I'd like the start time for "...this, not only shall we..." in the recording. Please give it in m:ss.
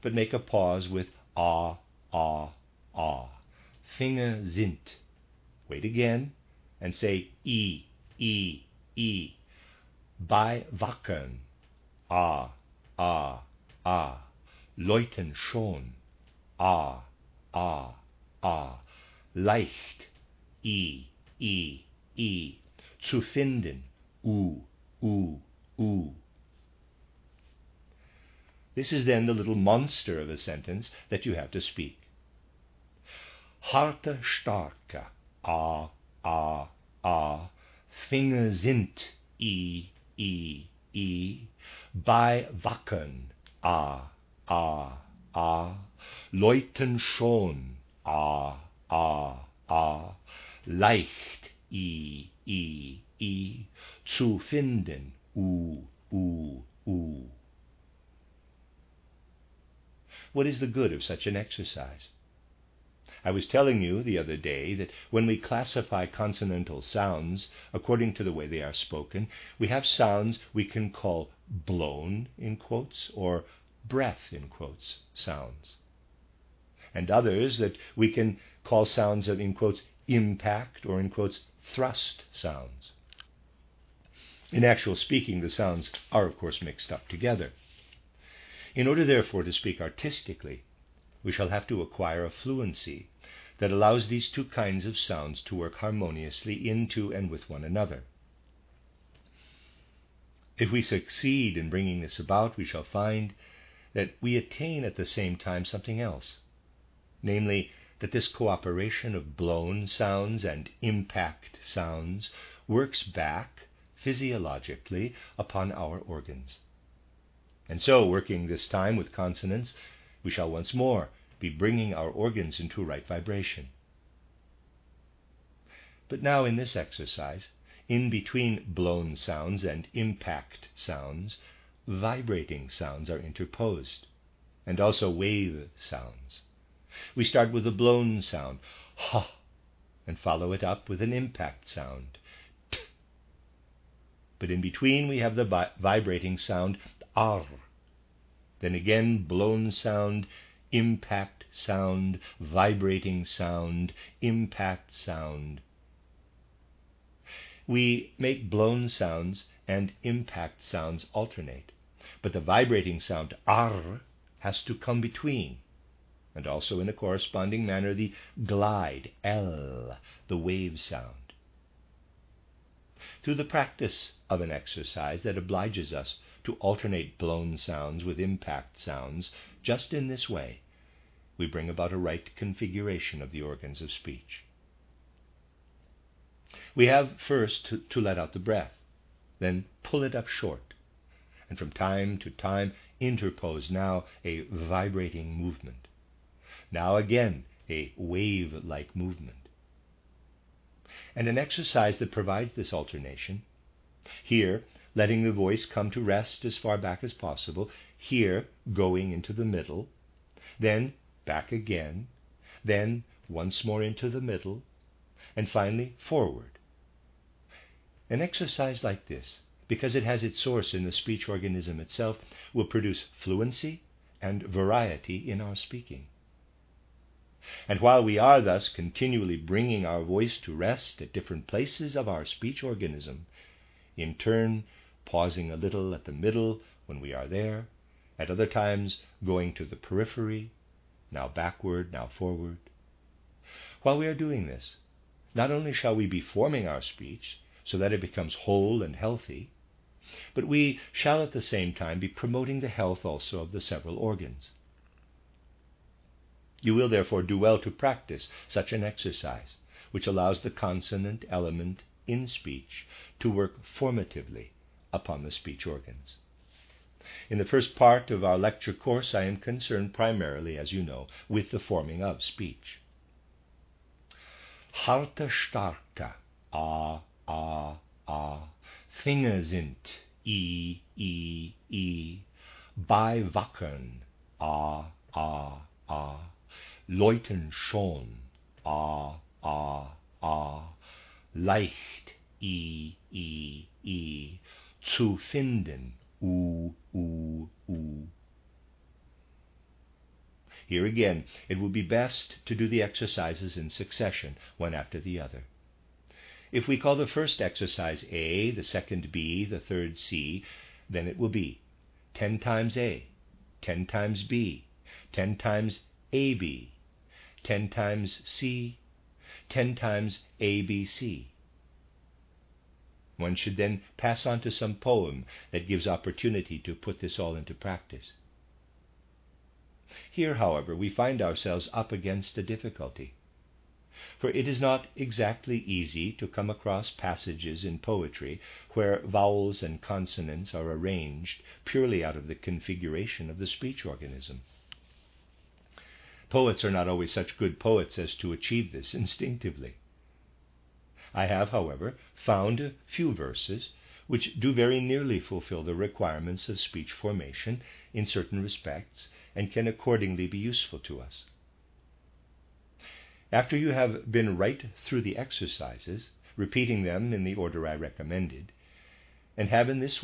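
4:04.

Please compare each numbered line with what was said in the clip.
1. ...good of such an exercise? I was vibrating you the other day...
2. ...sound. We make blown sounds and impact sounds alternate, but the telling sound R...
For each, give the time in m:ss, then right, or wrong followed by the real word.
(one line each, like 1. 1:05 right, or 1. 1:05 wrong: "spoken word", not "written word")
1. 1:00 wrong: "telling", not "vibrating"
2. 2:34 wrong: "vibrating", not "telling".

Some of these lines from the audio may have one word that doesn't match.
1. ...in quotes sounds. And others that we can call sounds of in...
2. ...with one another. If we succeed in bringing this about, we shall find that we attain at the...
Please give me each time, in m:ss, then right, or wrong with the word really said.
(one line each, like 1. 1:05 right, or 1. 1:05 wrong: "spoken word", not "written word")
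1. 1:14 right
2. 1:37 right.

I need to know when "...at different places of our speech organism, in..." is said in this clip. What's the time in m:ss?
3:50.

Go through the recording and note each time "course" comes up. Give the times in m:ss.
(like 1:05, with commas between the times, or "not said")
1:26, 4:28.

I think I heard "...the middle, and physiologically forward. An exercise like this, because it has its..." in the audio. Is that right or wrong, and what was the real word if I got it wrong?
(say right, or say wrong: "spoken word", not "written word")
wrong: "finally", not "physiologically".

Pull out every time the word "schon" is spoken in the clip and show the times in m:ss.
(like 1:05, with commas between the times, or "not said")
0:15, 0:46, 4:47.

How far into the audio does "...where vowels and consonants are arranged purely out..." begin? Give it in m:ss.
5:38.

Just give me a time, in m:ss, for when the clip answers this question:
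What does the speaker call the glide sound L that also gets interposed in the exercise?
2:50.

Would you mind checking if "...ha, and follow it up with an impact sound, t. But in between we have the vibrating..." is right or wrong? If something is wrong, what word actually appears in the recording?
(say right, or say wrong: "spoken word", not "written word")
right.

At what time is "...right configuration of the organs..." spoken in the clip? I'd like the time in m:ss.
3:01.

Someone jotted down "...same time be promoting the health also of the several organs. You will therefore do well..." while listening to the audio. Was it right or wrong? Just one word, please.
right.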